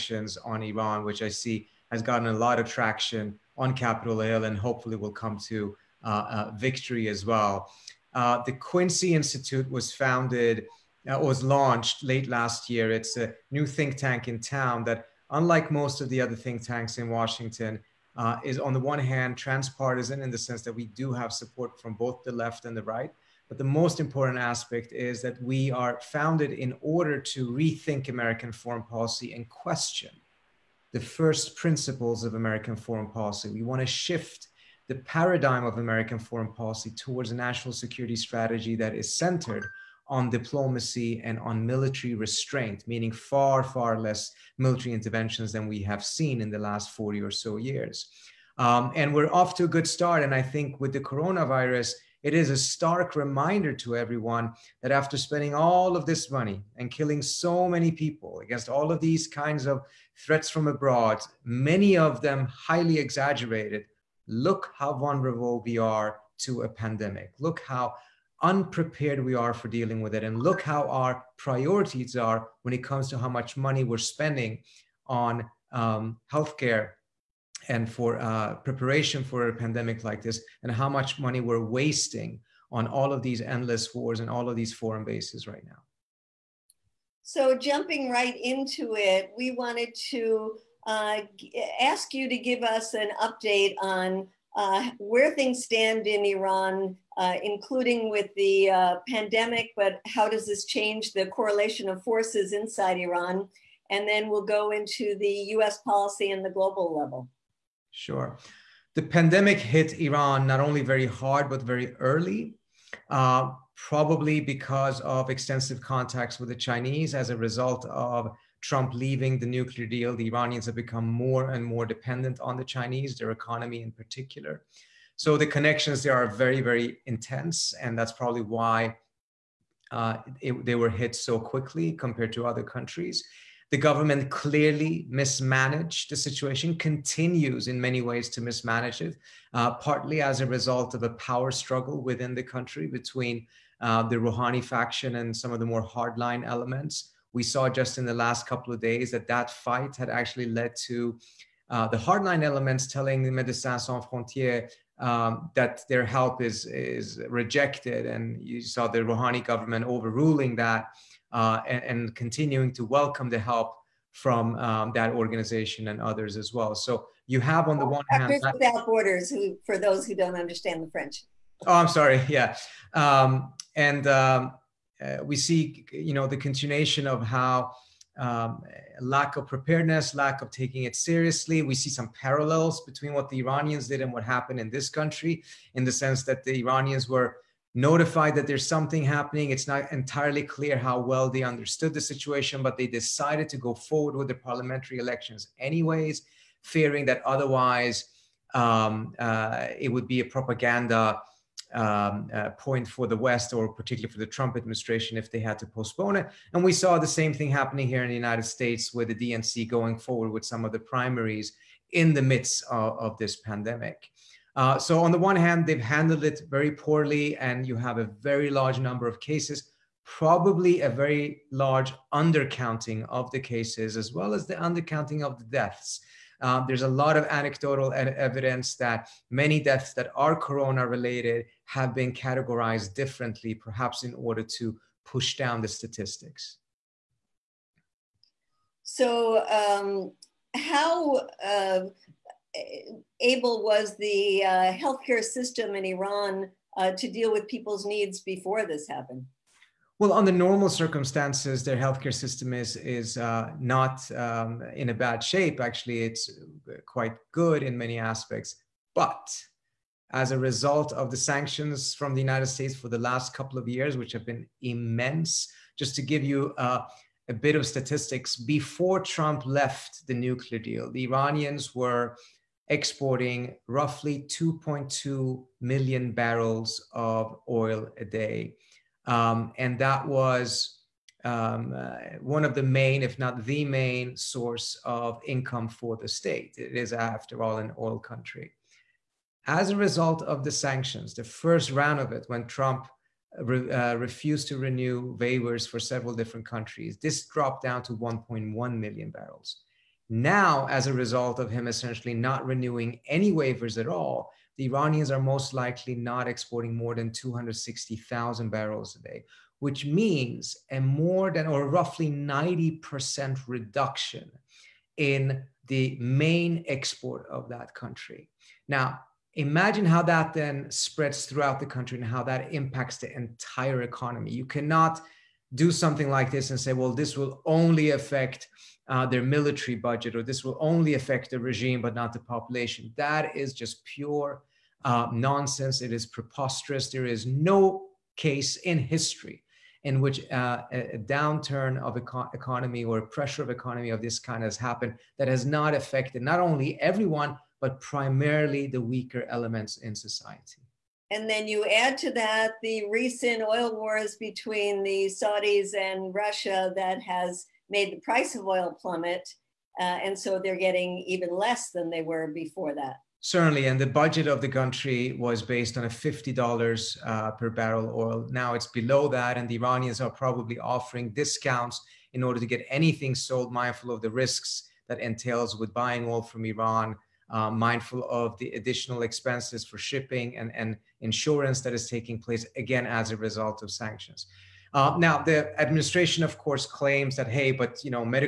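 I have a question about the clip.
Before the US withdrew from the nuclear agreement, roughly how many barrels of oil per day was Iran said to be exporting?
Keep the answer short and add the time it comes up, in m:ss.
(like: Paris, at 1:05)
2.2 million barrels, at 4:34.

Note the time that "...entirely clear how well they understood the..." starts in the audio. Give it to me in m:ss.
3:09.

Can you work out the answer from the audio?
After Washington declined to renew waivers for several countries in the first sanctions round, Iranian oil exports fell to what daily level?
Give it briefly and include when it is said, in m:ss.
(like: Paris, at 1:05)
1.1 million barrels, at 4:57.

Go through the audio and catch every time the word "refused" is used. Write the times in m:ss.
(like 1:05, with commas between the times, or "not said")
4:53.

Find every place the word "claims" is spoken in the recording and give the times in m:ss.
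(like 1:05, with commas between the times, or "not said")
6:26.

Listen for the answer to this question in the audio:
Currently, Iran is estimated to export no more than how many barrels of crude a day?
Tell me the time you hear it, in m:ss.
5:07.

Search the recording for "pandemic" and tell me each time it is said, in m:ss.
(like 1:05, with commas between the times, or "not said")
1:06, 1:19, 1:39, 1:49, 3:33.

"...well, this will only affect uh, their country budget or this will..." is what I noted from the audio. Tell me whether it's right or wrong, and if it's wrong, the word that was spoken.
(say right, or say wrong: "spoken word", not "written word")
wrong: "military", not "country".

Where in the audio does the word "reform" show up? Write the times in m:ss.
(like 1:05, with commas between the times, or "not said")
not said.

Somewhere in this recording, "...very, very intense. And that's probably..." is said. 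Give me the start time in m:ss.
2:06.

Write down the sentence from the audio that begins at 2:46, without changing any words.
So you have on the one hand Doctors Without Borders, who for those who don't understand the French.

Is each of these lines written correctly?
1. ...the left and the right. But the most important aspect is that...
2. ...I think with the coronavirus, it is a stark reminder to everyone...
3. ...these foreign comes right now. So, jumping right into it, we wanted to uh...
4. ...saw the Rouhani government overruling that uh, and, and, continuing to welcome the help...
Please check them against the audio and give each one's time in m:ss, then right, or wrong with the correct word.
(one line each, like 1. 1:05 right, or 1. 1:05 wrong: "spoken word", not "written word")
1. 0:22 right
2. 0:50 right
3. 1:24 wrong: "bases", not "comes"
4. 2:38 right.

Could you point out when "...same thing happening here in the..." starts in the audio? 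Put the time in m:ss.
3:27.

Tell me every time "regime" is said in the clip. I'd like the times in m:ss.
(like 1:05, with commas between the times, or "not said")
5:31.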